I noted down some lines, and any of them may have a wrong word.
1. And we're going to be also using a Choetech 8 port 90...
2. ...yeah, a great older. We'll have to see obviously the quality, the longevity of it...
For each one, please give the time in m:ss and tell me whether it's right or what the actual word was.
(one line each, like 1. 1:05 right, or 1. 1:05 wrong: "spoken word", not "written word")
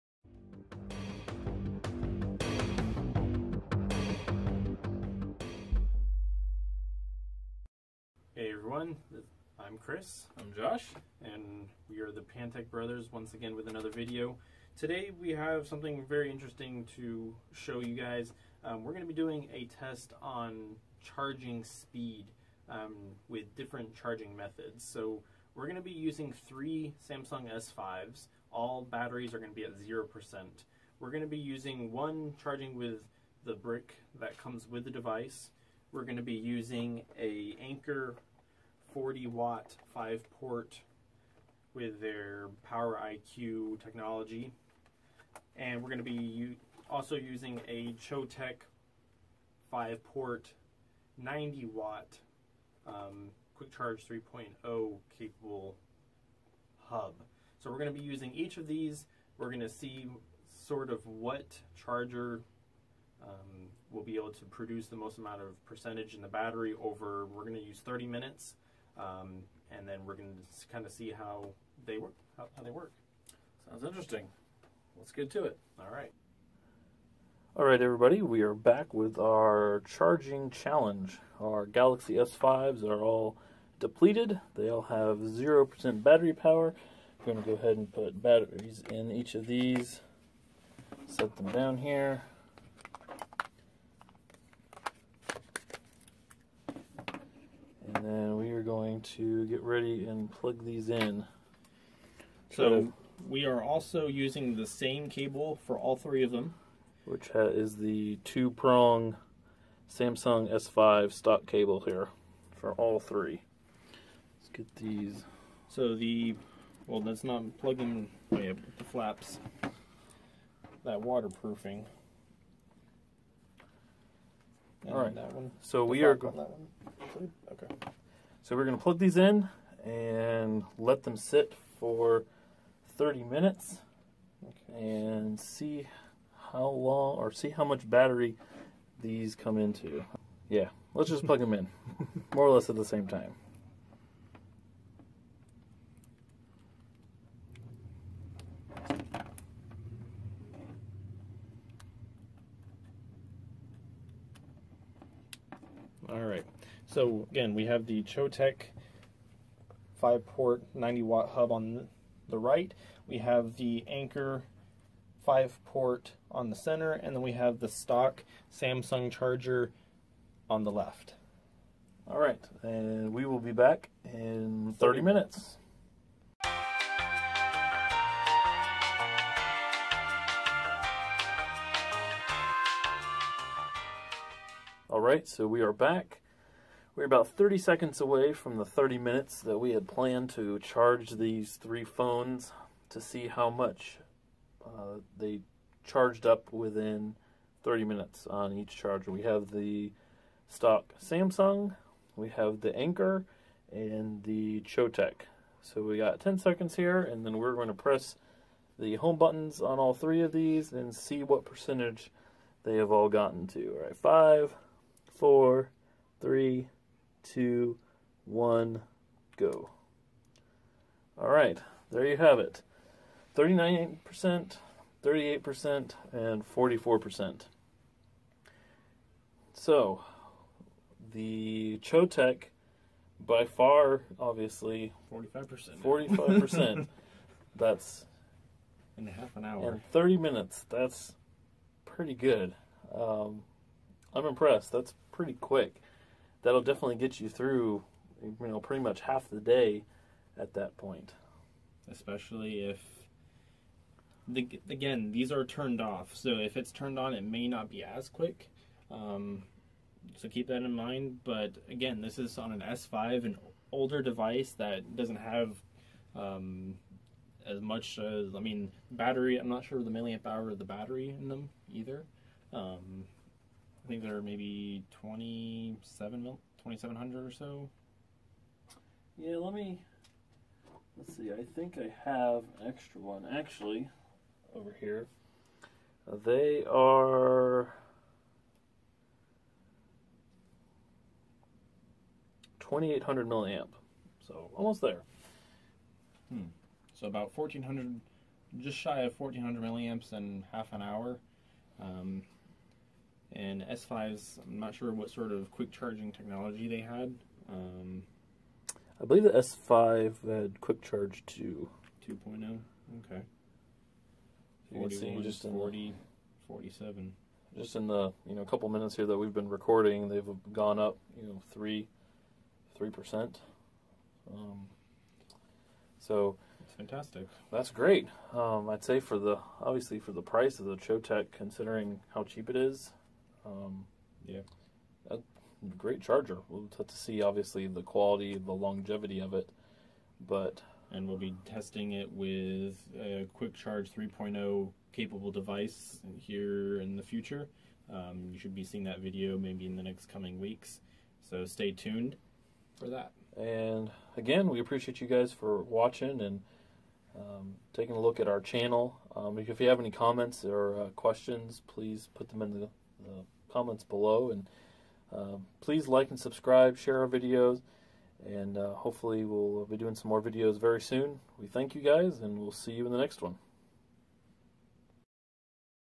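1. 0:45 wrong: "5", not "8"
2. 5:34 wrong: "charger", not "older".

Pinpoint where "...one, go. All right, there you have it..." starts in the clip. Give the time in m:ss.
3:38.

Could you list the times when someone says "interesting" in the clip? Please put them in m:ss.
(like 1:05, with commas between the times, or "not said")
0:16, 1:13.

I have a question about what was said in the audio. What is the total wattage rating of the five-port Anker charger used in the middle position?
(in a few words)
40 watt.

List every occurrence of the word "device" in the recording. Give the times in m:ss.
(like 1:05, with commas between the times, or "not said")
0:34, 4:24, 5:45.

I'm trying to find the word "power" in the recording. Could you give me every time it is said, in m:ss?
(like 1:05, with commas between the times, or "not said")
0:42, 1:26.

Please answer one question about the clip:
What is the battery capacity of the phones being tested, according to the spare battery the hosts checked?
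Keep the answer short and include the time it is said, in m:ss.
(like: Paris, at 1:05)
2800 milliamp, at 4:52.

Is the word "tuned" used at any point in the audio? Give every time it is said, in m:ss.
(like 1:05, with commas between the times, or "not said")
5:51.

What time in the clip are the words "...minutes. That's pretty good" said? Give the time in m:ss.
4:00.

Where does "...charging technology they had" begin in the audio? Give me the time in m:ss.
5:05.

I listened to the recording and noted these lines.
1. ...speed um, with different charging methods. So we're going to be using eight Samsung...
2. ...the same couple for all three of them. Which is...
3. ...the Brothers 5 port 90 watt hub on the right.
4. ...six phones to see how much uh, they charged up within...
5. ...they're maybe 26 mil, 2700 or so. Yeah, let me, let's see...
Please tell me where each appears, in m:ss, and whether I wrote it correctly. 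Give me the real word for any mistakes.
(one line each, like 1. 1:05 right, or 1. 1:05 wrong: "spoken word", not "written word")
1. 0:21 wrong: "three", not "eight"
2. 1:44 wrong: "cable", not "couple"
3. 2:37 wrong: "Choetech", not "Brothers"
4. 3:11 wrong: "three", not "six"
5. 4:34 wrong: "27", not "26".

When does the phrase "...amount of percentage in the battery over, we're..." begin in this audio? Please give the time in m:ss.
1:05.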